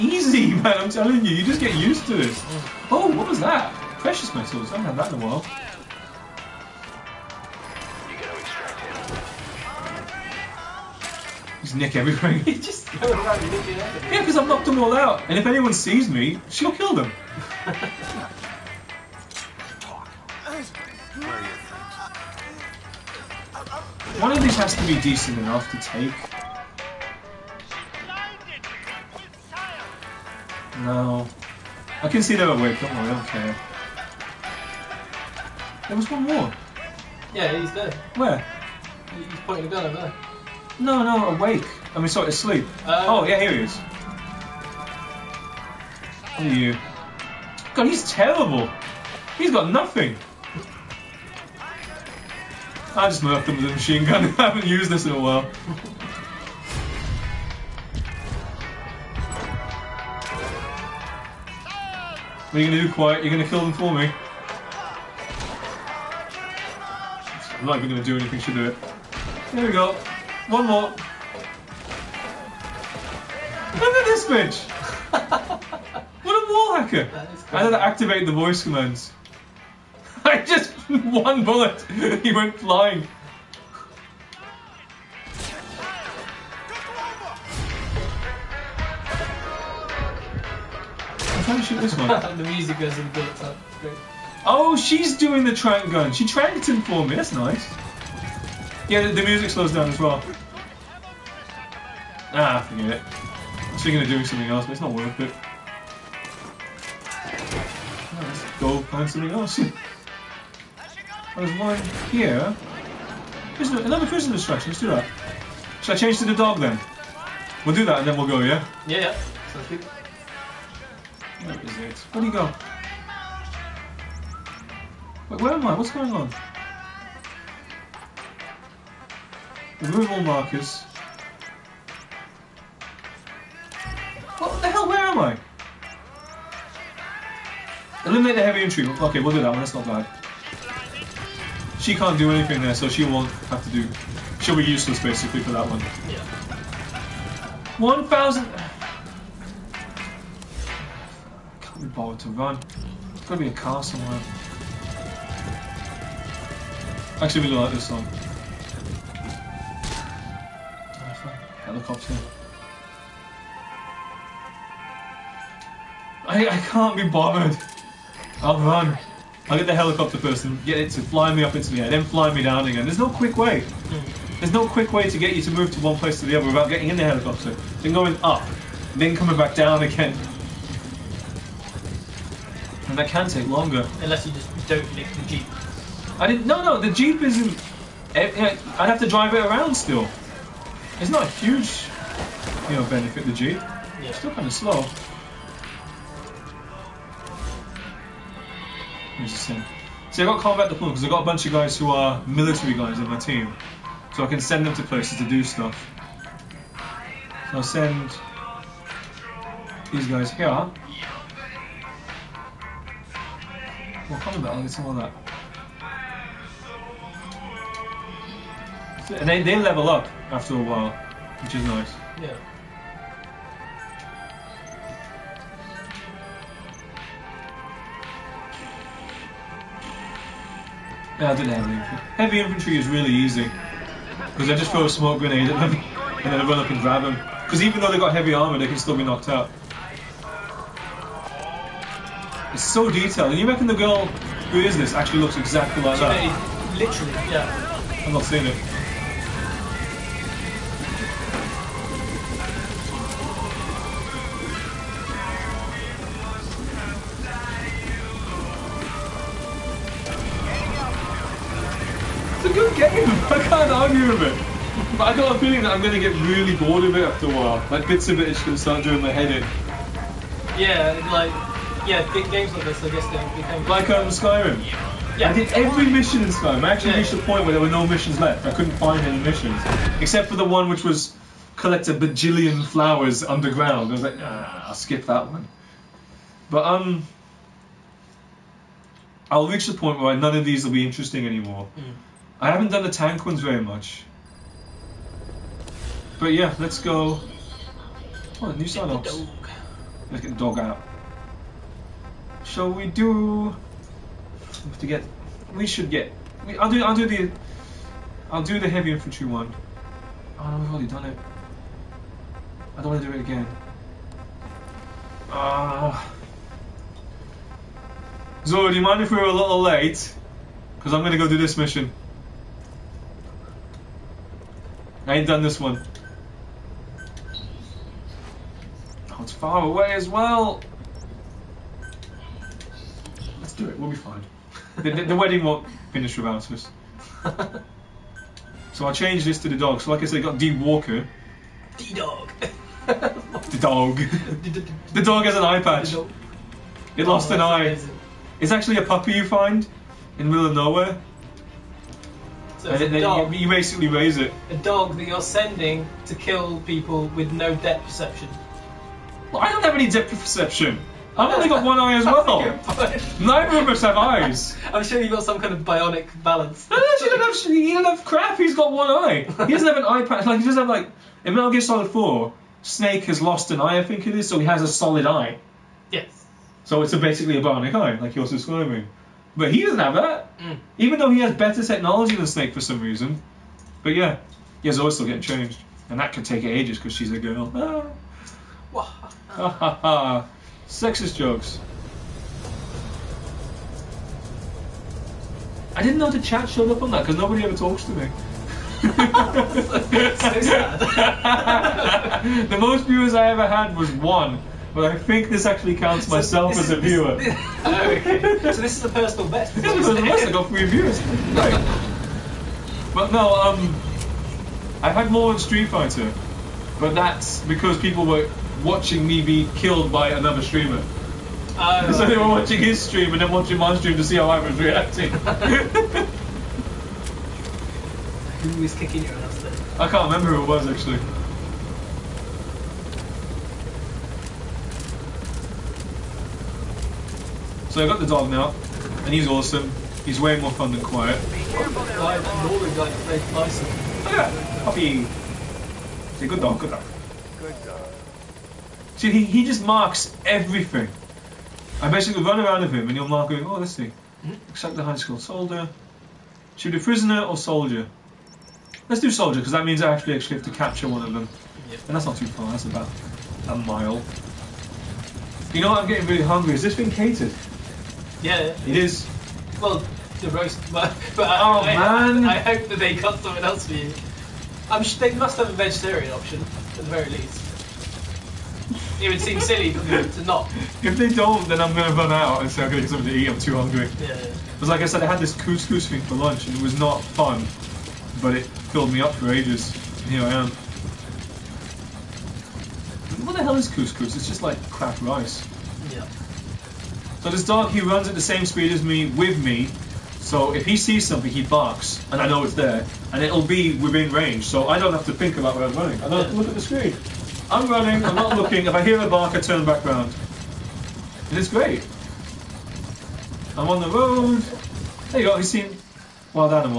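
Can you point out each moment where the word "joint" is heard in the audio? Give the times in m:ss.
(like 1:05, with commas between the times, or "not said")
not said.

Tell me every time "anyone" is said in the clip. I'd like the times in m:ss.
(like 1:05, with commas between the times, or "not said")
0:15.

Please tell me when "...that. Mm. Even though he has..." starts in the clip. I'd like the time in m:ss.
6:19.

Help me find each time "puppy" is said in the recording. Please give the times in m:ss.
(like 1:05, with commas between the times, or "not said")
5:48, 7:24.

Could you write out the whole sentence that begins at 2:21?
She can't do anything there, so she won't have to do...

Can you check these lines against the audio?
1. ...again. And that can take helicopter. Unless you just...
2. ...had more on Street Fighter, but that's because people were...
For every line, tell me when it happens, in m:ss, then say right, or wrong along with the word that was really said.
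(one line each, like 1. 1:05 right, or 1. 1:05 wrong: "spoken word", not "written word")
1. 2:59 wrong: "longer", not "helicopter"
2. 6:54 right.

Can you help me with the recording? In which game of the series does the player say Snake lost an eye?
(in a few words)
Metal Gear Solid 4.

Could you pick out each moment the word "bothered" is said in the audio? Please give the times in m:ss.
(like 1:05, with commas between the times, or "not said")
2:31, 2:47.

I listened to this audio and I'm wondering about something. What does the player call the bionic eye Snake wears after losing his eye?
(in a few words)
Solid eye.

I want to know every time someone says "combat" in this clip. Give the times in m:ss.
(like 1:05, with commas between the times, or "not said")
3:20, 3:34.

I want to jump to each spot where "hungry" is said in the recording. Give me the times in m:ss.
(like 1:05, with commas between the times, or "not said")
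7:46, 8:03.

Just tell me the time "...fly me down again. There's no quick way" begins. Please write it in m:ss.
2:52.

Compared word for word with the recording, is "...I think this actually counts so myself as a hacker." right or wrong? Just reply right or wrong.
wrong.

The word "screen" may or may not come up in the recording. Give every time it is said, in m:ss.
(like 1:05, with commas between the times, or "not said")
8:26.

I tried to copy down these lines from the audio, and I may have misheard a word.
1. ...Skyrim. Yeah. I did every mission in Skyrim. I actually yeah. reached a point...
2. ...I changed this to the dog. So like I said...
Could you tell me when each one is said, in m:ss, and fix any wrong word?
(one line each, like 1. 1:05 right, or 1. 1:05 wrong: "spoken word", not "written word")
1. 4:34 right
2. 5:38 right.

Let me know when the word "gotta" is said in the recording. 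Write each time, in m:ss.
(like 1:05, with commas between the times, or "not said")
2:33.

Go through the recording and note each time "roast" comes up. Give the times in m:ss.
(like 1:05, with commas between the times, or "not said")
7:50.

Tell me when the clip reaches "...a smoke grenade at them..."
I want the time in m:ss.
3:54.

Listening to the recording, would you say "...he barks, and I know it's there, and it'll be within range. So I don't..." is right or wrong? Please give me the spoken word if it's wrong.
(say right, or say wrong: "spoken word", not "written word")
right.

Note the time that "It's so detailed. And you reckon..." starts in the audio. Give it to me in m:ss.
4:02.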